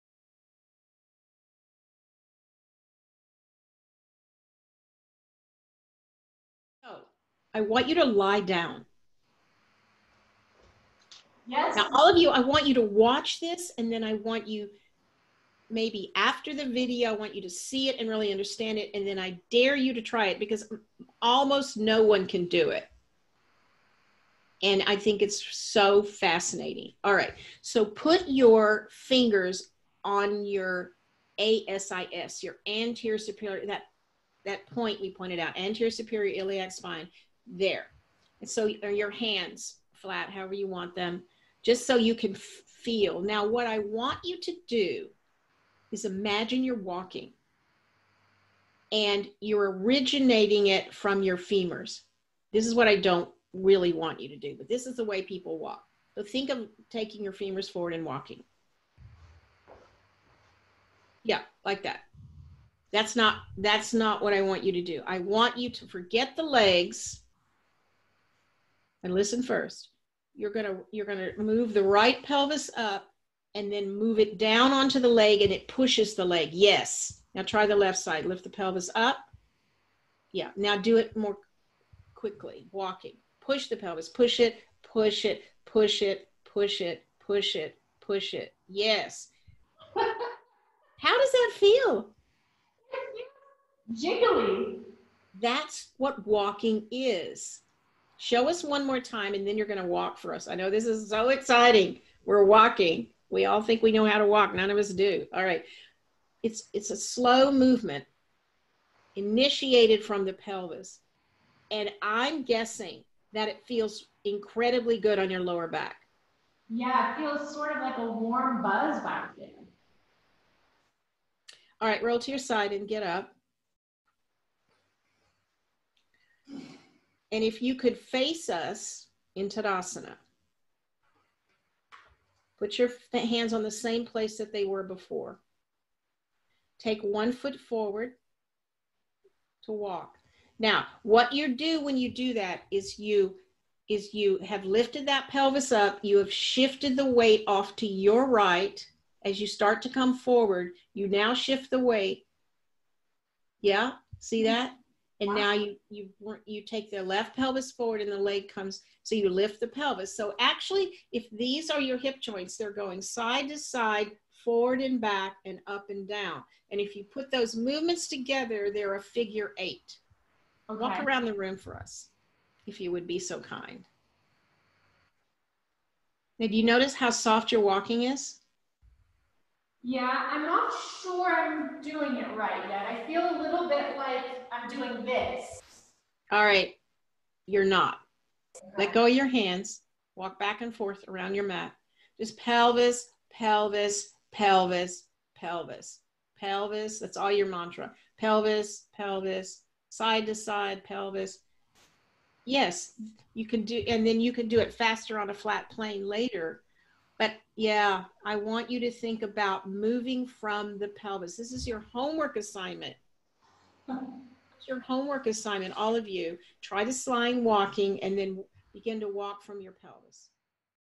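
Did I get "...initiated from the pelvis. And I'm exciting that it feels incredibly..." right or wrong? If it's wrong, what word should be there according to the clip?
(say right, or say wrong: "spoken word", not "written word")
wrong: "guessing", not "exciting".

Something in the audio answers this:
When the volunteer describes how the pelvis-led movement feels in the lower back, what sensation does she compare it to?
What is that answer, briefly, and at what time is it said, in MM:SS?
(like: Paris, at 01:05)
a warm buzz, at 01:57.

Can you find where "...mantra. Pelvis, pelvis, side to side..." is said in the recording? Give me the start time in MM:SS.
03:17.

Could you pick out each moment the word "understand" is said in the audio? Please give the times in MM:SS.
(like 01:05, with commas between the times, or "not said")
00:18.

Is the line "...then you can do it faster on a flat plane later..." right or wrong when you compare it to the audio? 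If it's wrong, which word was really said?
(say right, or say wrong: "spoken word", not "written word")
right.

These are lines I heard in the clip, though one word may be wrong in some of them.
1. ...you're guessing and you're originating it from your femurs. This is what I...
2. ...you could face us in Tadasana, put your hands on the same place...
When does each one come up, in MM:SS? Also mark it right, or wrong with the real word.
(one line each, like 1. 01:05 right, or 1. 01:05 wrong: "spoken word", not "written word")
1. 00:46 wrong: "walking", not "guessing"
2. 02:07 right.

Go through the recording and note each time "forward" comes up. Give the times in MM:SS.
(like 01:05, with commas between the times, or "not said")
00:57, 02:17, 02:30, 02:37, 02:44.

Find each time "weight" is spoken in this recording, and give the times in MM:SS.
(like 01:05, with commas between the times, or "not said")
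02:27, 02:31.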